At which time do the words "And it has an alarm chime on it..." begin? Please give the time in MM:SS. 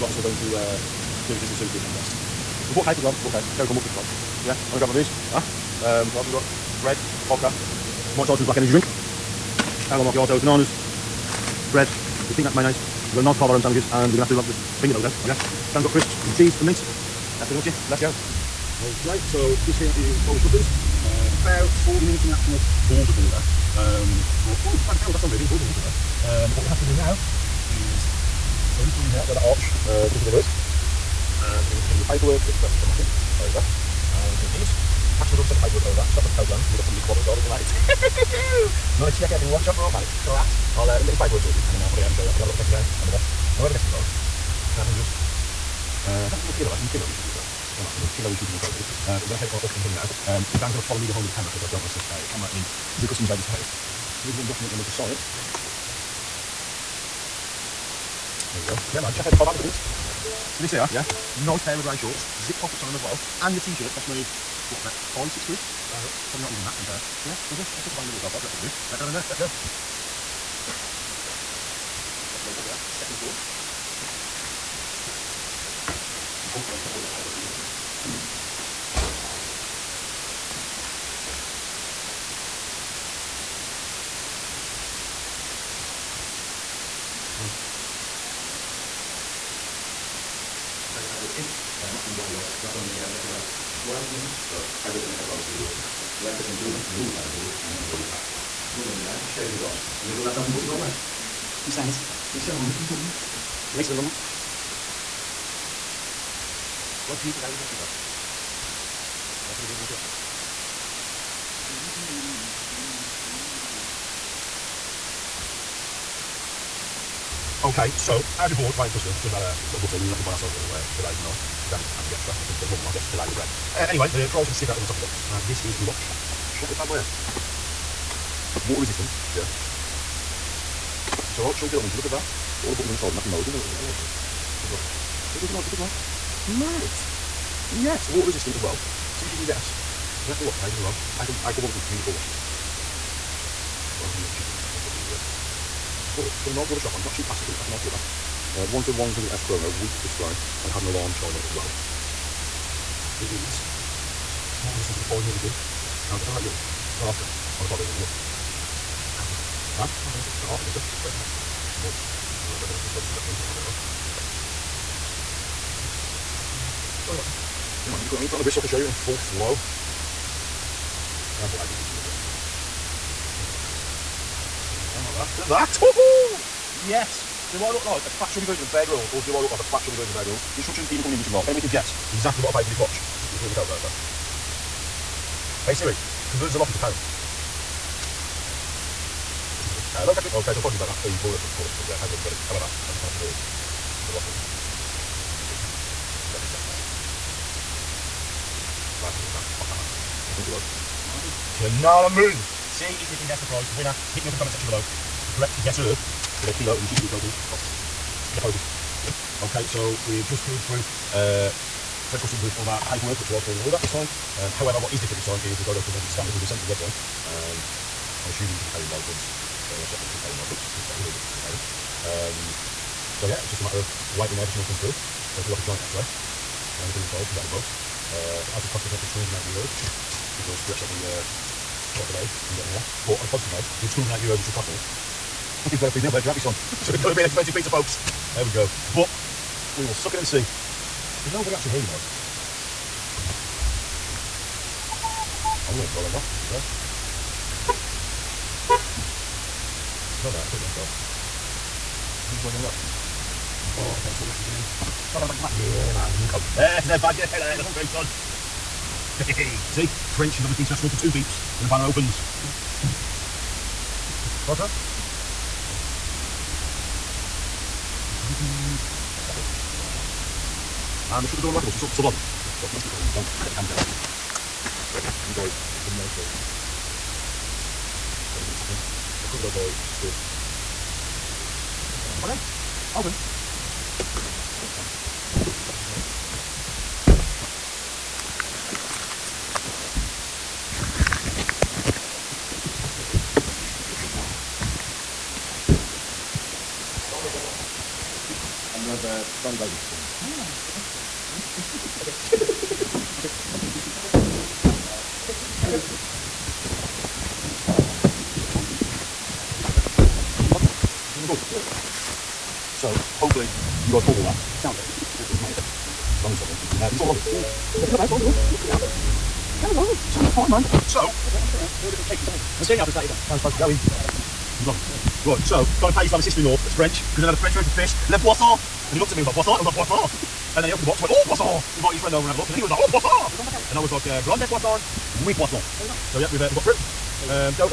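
02:30.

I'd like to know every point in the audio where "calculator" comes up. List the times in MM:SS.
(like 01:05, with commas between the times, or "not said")
03:03.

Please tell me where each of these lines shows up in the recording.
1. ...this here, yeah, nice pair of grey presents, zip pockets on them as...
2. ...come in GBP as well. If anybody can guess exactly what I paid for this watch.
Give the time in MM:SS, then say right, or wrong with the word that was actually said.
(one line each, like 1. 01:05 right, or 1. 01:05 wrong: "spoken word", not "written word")
1. 01:00 wrong: "shorts", not "presents"
2. 03:01 wrong: "English", not "GBP".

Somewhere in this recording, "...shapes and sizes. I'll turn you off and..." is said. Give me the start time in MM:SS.
05:22.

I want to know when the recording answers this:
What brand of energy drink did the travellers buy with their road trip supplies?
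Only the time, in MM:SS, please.
00:08.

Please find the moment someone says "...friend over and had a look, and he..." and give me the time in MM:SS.
05:31.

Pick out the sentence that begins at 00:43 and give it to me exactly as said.
And whoever guesses it both can have 100.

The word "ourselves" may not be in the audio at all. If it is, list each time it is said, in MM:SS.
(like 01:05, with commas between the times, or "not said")
01:40, 02:00.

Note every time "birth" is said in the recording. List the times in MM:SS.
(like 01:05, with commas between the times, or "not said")
not said.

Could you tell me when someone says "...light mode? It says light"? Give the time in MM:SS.
02:13.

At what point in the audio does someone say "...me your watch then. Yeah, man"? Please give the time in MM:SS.
02:47.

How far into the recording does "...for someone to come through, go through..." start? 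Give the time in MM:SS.
03:44.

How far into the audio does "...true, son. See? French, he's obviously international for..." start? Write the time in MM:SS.
04:17.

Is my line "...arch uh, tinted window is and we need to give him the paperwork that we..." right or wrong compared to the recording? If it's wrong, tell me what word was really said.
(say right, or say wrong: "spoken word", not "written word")
right.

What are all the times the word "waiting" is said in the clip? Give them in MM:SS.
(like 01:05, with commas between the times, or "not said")
01:58, 03:44.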